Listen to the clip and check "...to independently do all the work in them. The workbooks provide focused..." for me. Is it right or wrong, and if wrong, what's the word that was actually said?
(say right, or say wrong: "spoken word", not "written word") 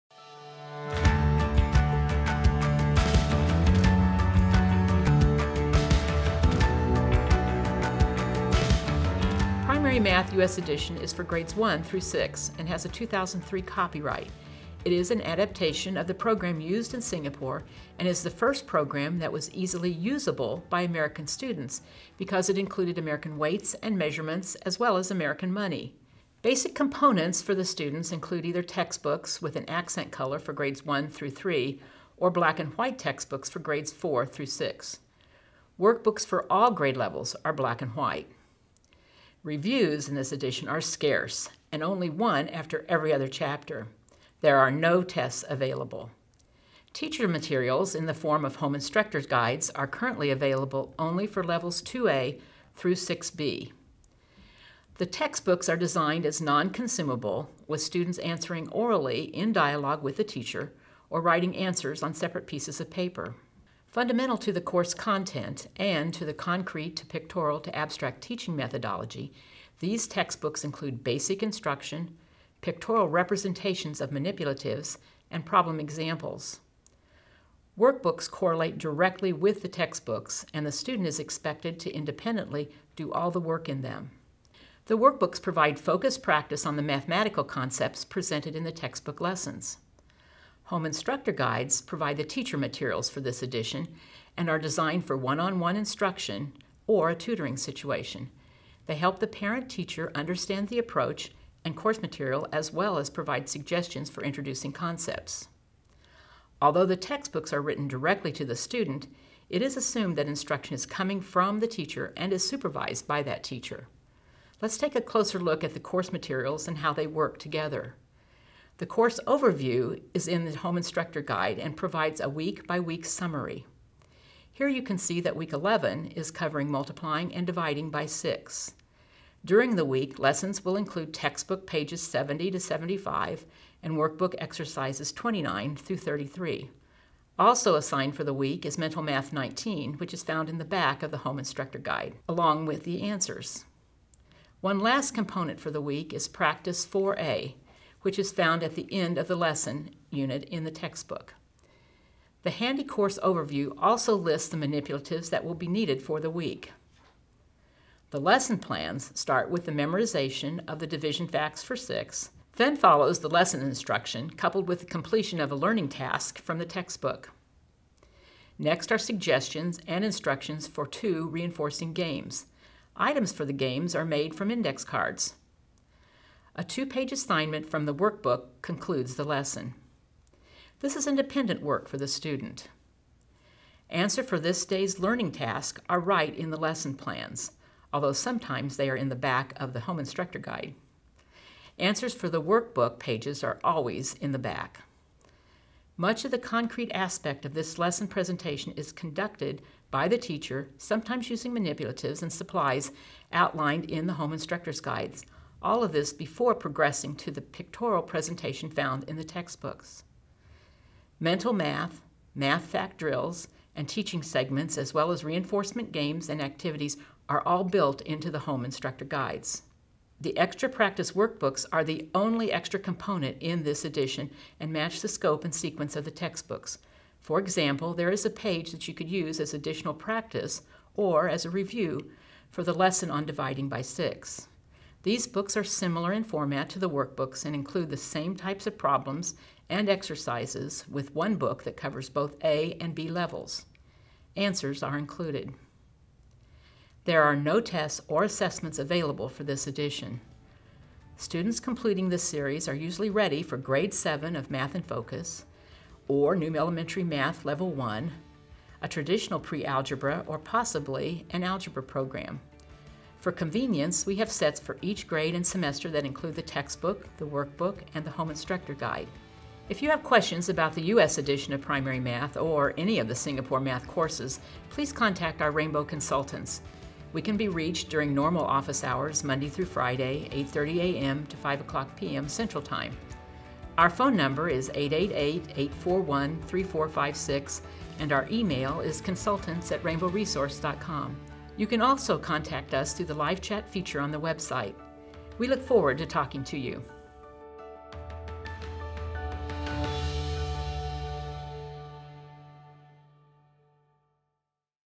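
right.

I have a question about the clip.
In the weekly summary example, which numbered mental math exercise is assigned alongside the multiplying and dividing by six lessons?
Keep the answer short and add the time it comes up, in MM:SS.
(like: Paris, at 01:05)
Mental Math 19, at 02:18.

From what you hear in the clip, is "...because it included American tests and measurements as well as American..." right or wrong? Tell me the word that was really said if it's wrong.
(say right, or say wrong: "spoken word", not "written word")
wrong: "weights", not "tests".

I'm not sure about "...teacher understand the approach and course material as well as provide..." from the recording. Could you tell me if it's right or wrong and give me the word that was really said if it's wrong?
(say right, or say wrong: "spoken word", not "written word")
right.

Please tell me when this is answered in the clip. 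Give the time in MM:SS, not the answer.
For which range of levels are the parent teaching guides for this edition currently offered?
00:51.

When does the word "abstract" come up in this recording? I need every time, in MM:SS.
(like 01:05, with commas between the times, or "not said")
01:07.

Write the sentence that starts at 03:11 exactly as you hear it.
Answers for the workbook pages are always in the back.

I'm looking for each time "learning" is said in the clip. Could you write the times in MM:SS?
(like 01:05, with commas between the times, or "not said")
02:45, 03:04.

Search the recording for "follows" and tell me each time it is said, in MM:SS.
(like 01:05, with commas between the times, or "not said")
02:42.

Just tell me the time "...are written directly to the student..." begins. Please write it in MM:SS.
01:47.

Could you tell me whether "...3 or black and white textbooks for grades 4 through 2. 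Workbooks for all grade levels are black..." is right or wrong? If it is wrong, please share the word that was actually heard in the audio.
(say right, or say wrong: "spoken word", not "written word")
wrong: "6", not "2".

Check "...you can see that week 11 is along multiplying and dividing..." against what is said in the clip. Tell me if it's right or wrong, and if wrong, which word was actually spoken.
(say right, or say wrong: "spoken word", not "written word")
wrong: "covering", not "along".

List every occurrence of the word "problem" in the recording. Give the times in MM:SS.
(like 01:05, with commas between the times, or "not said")
01:15, 03:58.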